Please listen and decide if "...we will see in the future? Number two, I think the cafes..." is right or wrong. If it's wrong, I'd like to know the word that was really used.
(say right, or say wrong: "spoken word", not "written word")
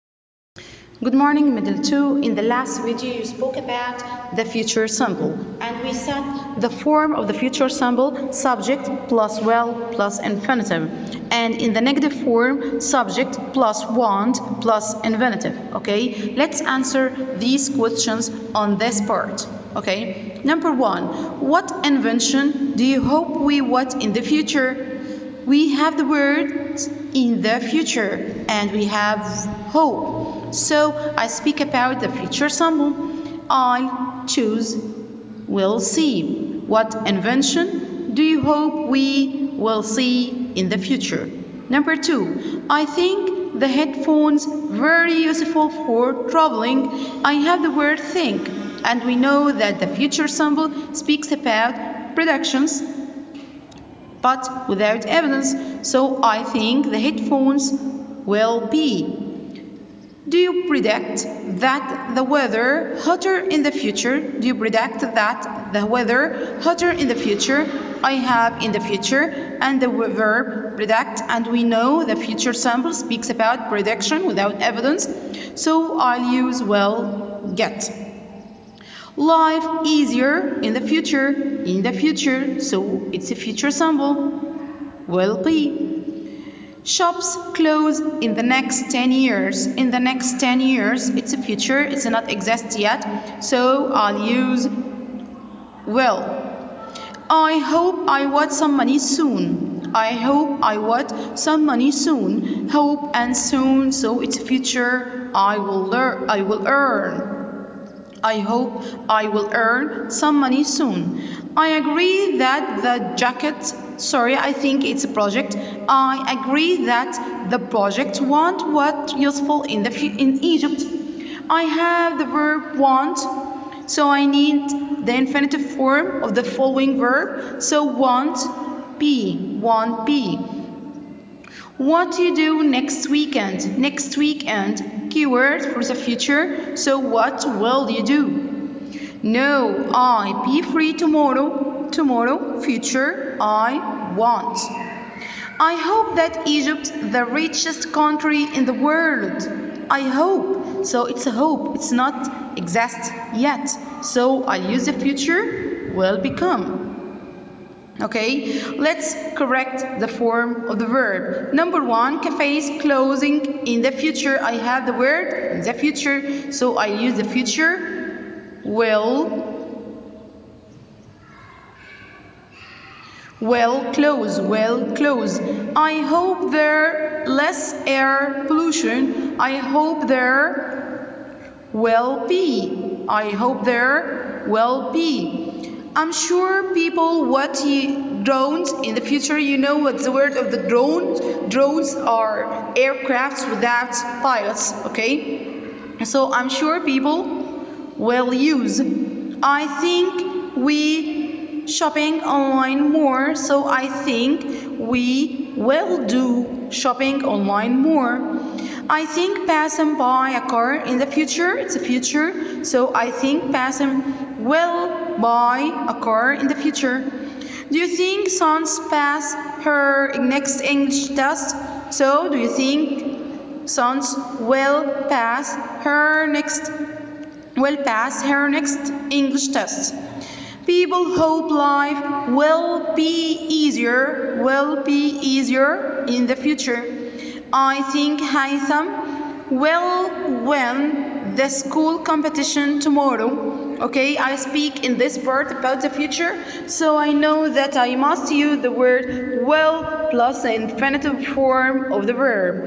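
wrong: "headphones", not "cafes".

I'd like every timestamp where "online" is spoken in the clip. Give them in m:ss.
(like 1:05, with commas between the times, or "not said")
3:22, 3:27.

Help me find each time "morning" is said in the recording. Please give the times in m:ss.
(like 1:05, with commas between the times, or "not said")
0:01.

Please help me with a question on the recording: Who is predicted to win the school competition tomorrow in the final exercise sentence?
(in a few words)
Haitham.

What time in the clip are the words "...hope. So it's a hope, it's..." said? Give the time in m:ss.
2:30.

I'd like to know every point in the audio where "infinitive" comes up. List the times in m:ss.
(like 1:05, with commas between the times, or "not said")
0:10, 0:15, 2:05, 4:10.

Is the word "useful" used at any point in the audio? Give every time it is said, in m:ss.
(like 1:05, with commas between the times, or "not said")
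0:45, 1:59.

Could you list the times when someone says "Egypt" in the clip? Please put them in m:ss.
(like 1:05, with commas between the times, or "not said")
2:00, 2:26.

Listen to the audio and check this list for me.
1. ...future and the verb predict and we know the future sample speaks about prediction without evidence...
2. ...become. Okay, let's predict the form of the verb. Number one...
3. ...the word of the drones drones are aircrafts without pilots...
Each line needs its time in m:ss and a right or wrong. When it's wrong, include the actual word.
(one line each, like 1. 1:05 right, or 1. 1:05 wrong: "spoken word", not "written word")
1. 1:08 right
2. 2:36 wrong: "correct", not "predict"
3. 3:10 right.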